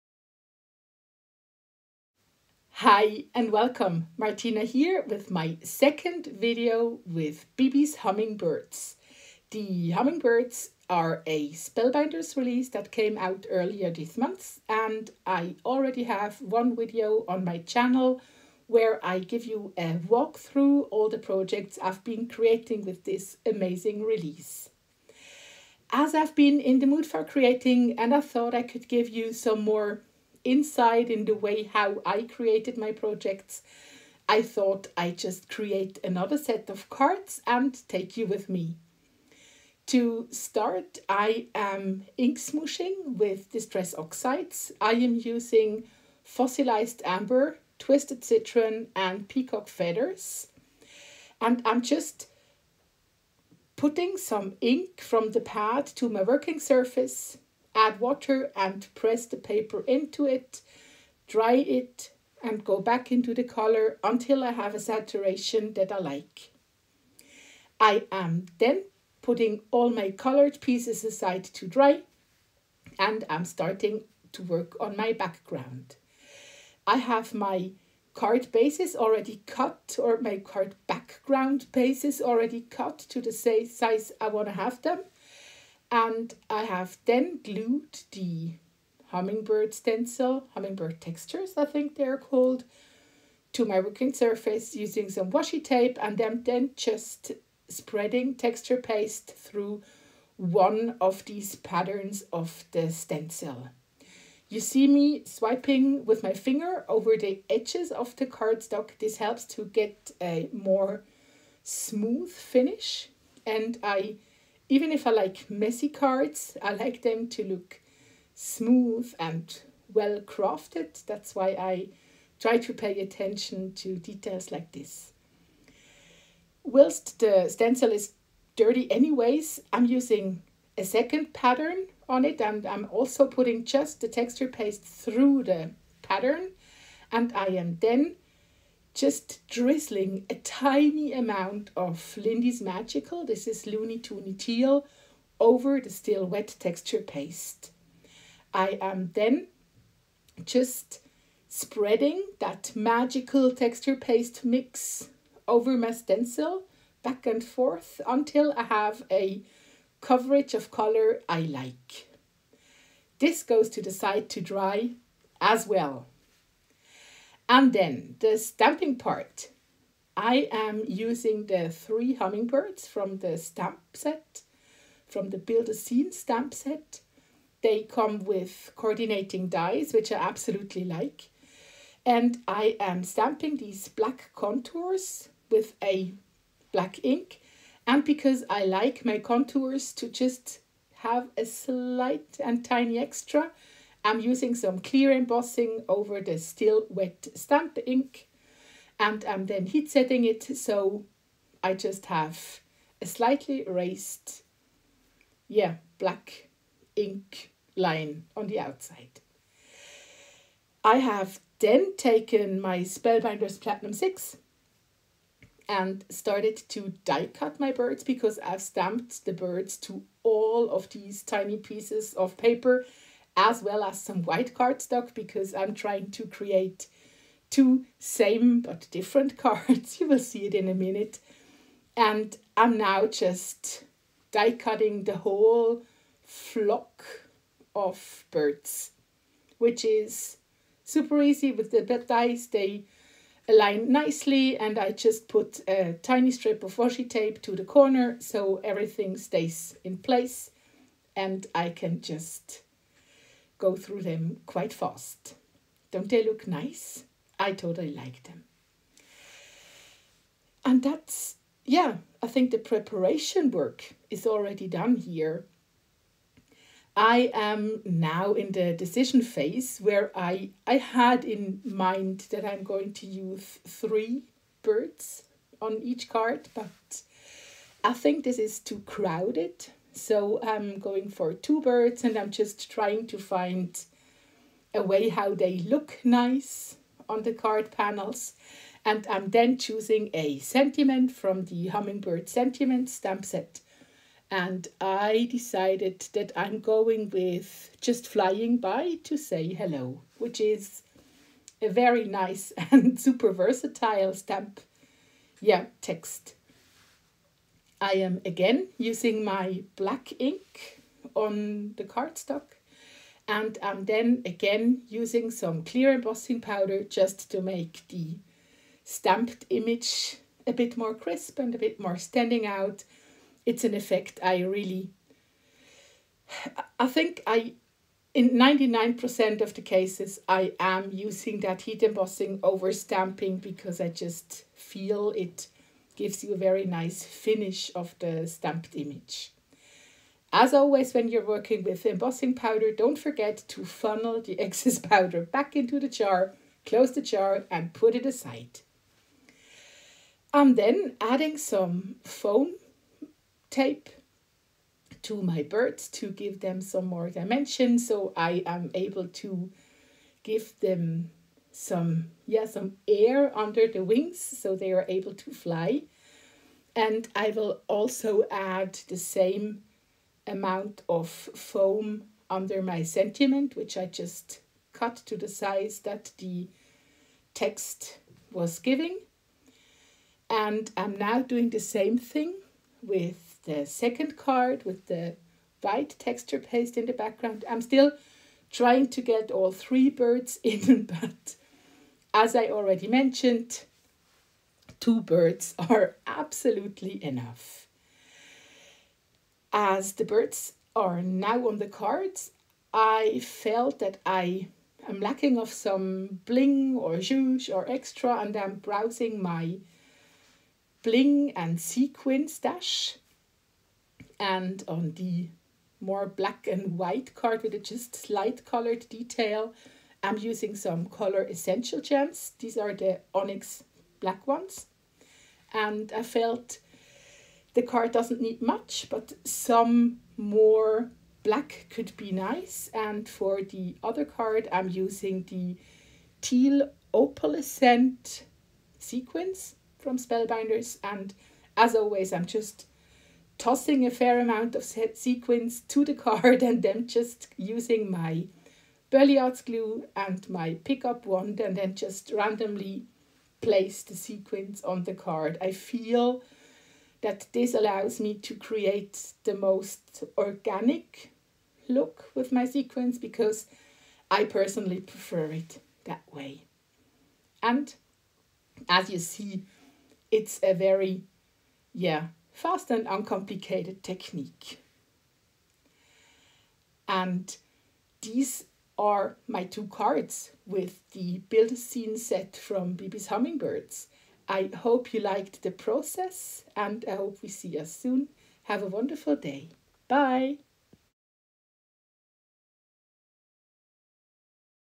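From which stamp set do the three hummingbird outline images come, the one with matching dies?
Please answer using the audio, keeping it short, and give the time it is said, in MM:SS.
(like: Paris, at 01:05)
Build a Scene, at 02:55.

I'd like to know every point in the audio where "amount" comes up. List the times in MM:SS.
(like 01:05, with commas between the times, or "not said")
02:21, 06:10, 07:24.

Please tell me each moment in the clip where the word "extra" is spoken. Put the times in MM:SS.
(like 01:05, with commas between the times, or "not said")
03:12, 06:47.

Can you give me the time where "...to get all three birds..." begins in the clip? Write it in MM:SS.
06:28.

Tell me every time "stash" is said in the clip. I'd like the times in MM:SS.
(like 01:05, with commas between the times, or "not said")
06:52.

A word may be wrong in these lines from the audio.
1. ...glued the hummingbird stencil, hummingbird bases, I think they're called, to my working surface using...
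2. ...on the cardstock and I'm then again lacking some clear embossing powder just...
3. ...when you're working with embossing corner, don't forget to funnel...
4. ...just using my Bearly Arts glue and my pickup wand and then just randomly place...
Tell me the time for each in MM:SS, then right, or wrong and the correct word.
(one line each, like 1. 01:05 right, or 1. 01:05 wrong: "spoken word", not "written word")
1. 01:27 wrong: "textures", not "bases"
2. 05:11 wrong: "using", not "lacking"
3. 05:40 wrong: "powder", not "corner"
4. 07:26 right.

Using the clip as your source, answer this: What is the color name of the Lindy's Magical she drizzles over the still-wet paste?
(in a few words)
Loonie Toonie Teal.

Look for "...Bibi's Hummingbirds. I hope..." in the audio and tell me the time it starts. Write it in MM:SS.
08:02.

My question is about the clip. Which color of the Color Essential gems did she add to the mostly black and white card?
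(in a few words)
onyx black.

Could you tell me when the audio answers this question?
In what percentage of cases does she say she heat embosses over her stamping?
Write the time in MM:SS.
05:28.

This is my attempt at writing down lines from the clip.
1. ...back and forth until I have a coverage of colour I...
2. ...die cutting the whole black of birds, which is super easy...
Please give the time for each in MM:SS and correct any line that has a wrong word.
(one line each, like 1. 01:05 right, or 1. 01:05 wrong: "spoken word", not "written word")
1. 02:37 right
2. 03:54 wrong: "flock", not "black".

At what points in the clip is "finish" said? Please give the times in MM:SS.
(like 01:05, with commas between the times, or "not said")
01:52, 05:37.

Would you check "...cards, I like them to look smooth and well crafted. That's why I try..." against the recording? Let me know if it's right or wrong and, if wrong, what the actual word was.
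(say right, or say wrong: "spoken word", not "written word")
right.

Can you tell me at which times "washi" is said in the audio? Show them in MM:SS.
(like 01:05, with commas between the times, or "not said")
01:35, 04:06.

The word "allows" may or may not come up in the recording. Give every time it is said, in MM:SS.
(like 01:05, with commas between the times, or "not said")
07:37.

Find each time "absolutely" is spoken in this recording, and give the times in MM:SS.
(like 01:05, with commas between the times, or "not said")
03:00, 06:36.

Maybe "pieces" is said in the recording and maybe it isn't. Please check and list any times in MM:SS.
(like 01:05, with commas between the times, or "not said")
01:10, 03:41.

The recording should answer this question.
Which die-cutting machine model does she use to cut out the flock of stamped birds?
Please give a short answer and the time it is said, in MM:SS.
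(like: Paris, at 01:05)
Spellbinders Platinum 6, at 03:32.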